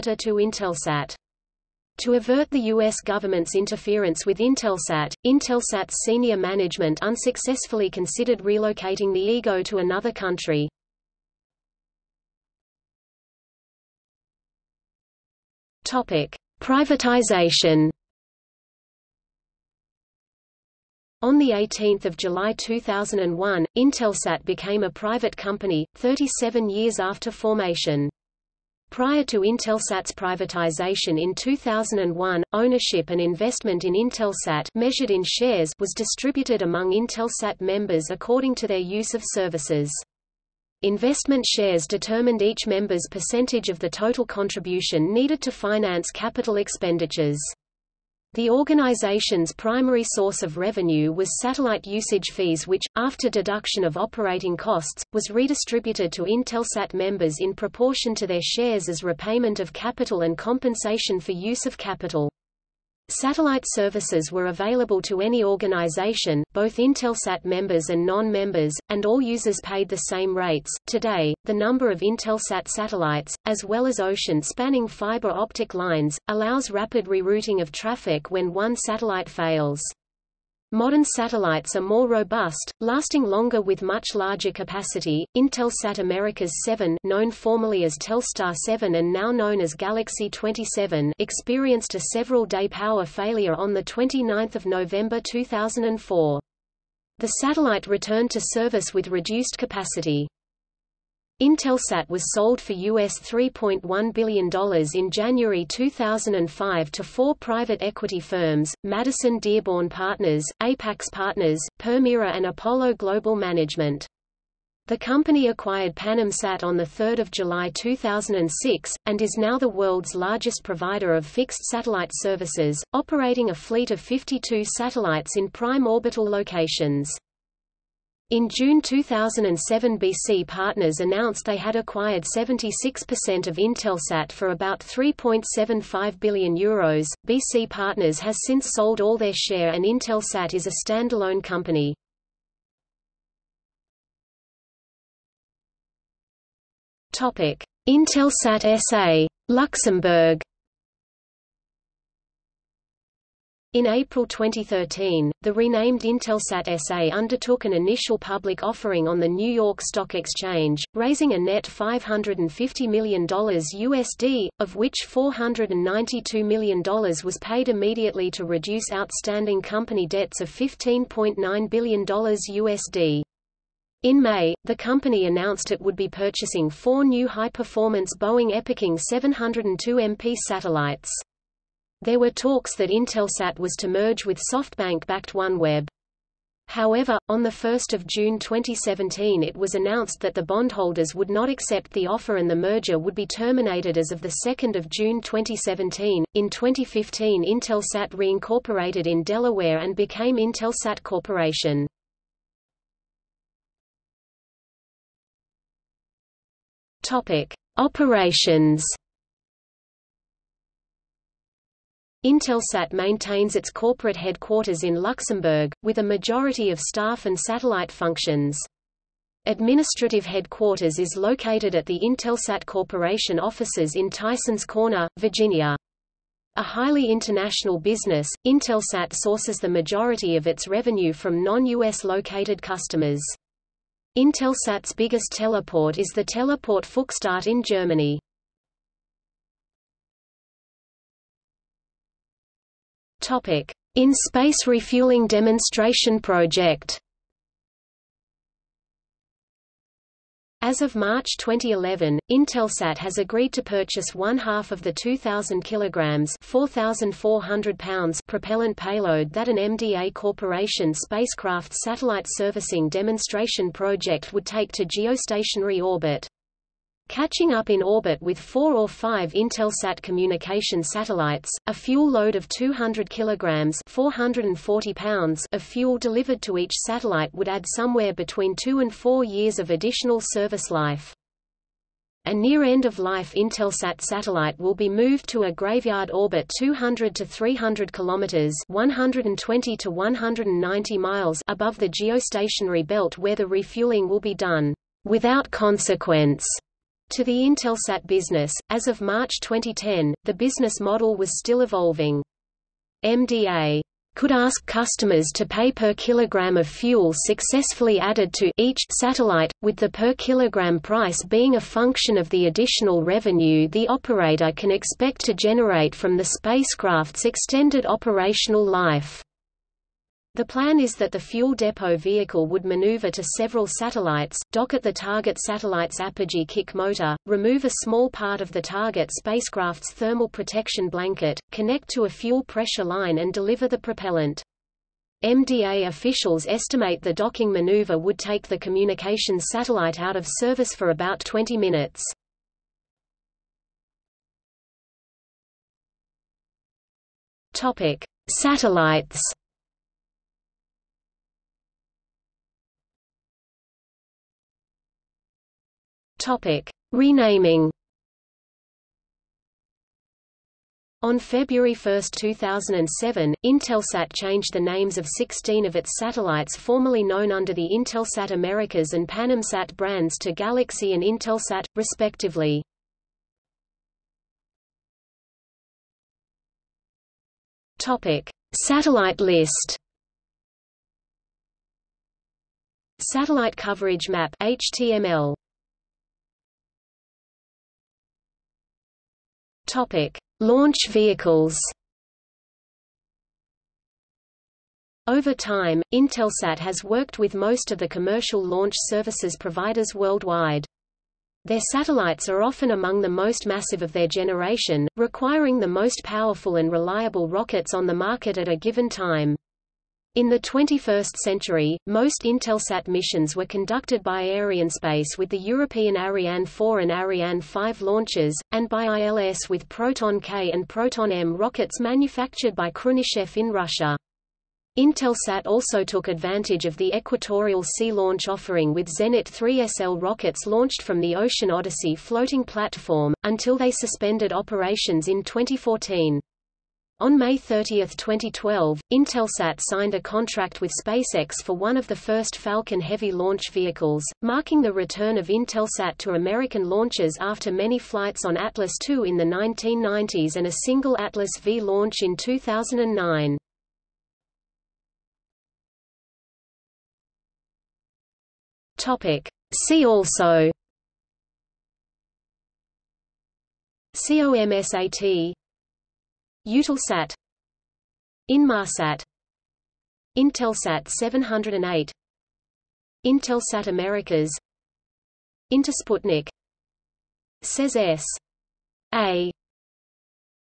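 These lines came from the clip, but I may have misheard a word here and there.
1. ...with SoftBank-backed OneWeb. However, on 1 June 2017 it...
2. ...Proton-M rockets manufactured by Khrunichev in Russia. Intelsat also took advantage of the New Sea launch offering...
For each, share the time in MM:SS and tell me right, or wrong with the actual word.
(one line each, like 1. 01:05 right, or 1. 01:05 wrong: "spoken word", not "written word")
1. 03:04 right
2. 07:00 wrong: "Equatorial", not "New".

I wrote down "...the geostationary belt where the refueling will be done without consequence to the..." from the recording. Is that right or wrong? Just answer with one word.
right.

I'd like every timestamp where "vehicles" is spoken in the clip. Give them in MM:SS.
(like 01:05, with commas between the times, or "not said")
05:21, 06:30, 07:23.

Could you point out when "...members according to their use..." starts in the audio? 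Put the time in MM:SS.
00:37.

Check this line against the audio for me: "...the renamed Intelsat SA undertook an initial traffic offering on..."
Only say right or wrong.
wrong.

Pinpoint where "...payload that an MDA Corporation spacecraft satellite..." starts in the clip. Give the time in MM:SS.
04:18.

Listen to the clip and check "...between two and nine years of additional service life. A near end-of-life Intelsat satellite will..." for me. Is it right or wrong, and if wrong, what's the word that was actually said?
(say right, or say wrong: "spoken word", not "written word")
wrong: "four", not "nine".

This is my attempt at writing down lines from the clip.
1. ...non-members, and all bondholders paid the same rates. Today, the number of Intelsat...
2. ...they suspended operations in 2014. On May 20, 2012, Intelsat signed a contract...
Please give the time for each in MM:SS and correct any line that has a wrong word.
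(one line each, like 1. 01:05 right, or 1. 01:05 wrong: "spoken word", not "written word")
1. 01:08 wrong: "users", not "bondholders"
2. 07:13 wrong: "30", not "20".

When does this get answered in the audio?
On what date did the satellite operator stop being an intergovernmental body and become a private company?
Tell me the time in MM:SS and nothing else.
00:21.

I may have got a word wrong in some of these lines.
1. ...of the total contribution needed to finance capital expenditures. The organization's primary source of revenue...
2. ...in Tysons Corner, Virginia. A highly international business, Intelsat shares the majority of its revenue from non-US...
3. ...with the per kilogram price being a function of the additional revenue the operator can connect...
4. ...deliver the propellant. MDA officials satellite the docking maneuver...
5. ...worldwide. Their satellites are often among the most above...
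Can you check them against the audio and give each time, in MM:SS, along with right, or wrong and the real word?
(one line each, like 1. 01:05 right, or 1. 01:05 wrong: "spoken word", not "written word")
1. 00:43 right
2. 03:43 wrong: "sources", not "shares"
3. 05:09 wrong: "expect", not "connect"
4. 05:33 wrong: "estimate", not "satellite"
5. 06:39 wrong: "massive", not "above".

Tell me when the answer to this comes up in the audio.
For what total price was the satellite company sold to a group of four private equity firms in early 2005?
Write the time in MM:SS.
01:42.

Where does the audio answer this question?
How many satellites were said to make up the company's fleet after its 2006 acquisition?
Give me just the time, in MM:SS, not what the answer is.
02:04.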